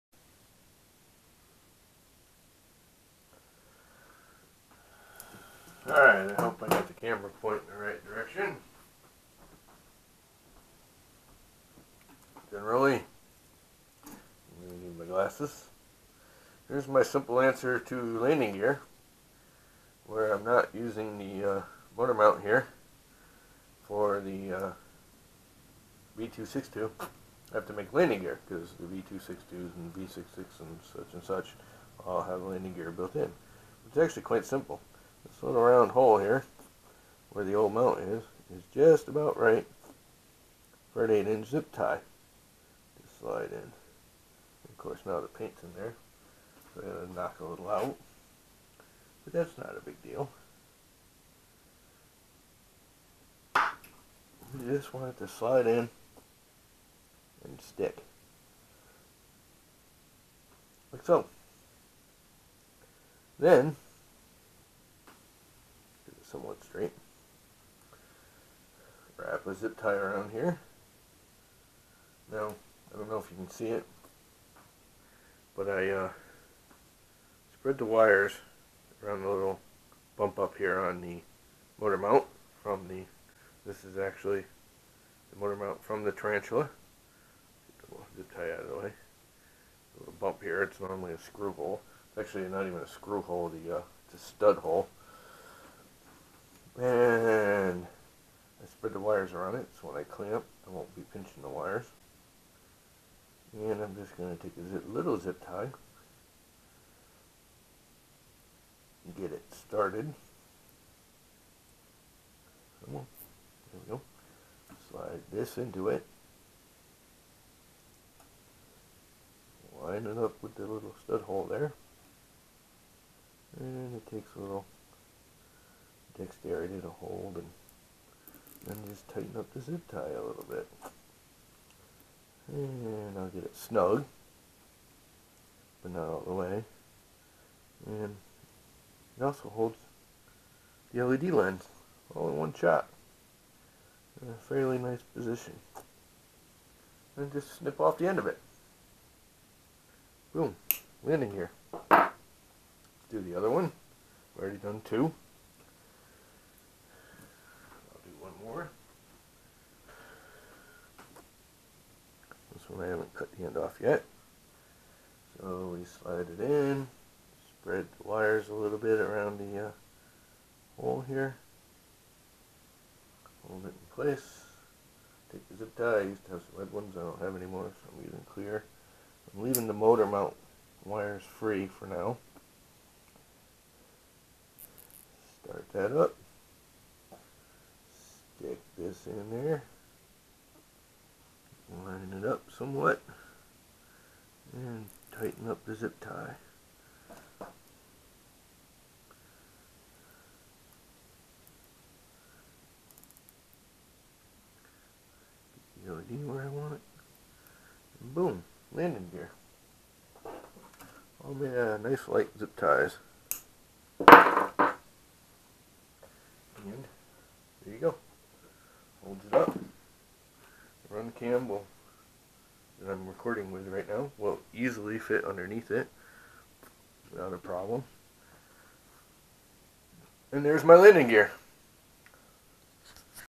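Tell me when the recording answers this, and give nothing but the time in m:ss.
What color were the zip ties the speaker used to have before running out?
2:56.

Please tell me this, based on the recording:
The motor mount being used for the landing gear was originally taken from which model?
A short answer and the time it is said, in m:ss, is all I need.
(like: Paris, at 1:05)
Tarantula, at 1:26.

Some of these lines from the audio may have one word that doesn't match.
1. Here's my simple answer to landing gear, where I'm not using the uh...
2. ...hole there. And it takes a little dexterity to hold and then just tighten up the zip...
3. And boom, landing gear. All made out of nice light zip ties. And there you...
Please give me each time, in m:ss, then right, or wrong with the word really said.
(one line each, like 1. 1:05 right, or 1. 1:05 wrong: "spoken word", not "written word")
1. 0:16 right
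2. 2:01 right
3. 3:27 right.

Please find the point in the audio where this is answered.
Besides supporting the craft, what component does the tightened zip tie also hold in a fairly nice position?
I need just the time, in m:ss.
2:21.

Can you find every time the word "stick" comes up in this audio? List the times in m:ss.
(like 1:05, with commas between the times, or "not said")
0:57, 3:08.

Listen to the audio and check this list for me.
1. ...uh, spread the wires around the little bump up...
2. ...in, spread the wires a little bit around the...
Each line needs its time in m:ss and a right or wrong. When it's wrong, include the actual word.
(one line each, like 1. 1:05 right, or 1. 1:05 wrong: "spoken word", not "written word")
1. 1:15 right
2. 2:46 right.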